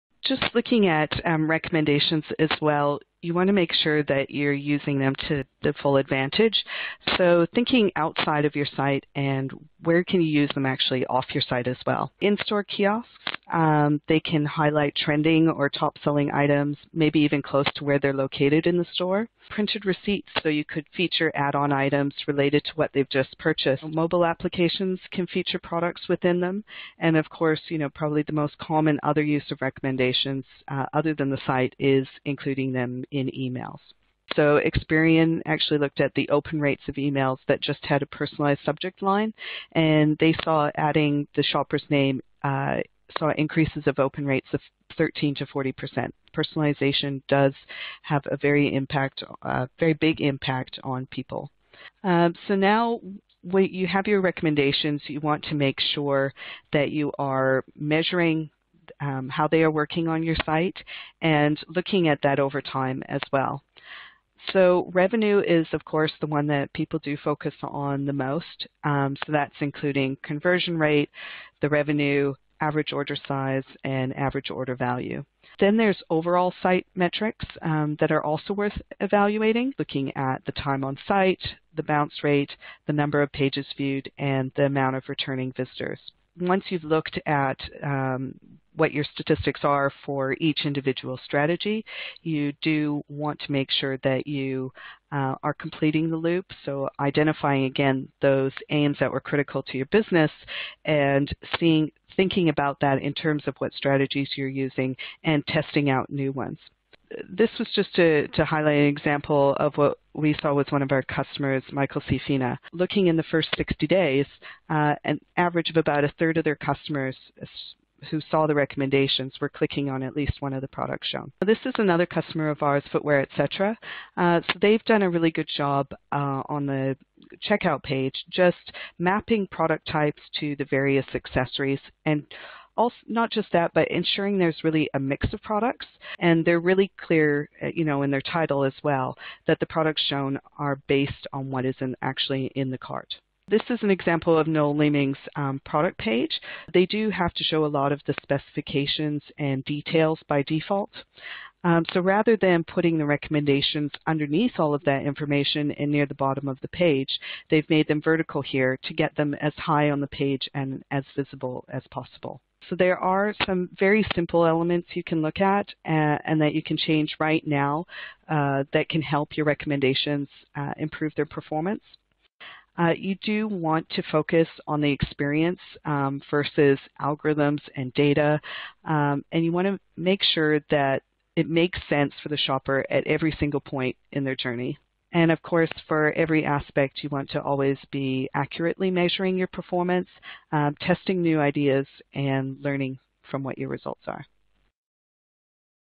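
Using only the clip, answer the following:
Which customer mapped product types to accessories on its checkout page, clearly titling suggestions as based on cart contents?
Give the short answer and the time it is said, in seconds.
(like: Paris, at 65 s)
Footwear Etc., at 122 s.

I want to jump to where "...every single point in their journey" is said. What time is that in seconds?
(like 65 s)
183 s.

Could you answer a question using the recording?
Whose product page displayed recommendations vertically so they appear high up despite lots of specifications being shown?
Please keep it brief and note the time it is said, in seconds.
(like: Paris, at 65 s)
Noel Leeming, at 144 s.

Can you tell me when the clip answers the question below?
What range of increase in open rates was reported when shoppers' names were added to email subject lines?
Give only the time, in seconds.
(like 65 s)
44 s.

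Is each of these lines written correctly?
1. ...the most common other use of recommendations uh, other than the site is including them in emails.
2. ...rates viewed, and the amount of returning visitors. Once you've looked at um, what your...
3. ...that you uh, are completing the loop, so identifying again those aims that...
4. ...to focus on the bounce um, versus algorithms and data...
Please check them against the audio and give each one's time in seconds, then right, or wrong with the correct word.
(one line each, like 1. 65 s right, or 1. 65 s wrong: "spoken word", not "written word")
1. 28 s right
2. 83 s wrong: "pages", not "rates"
3. 94 s right
4. 173 s wrong: "experience", not "bounce".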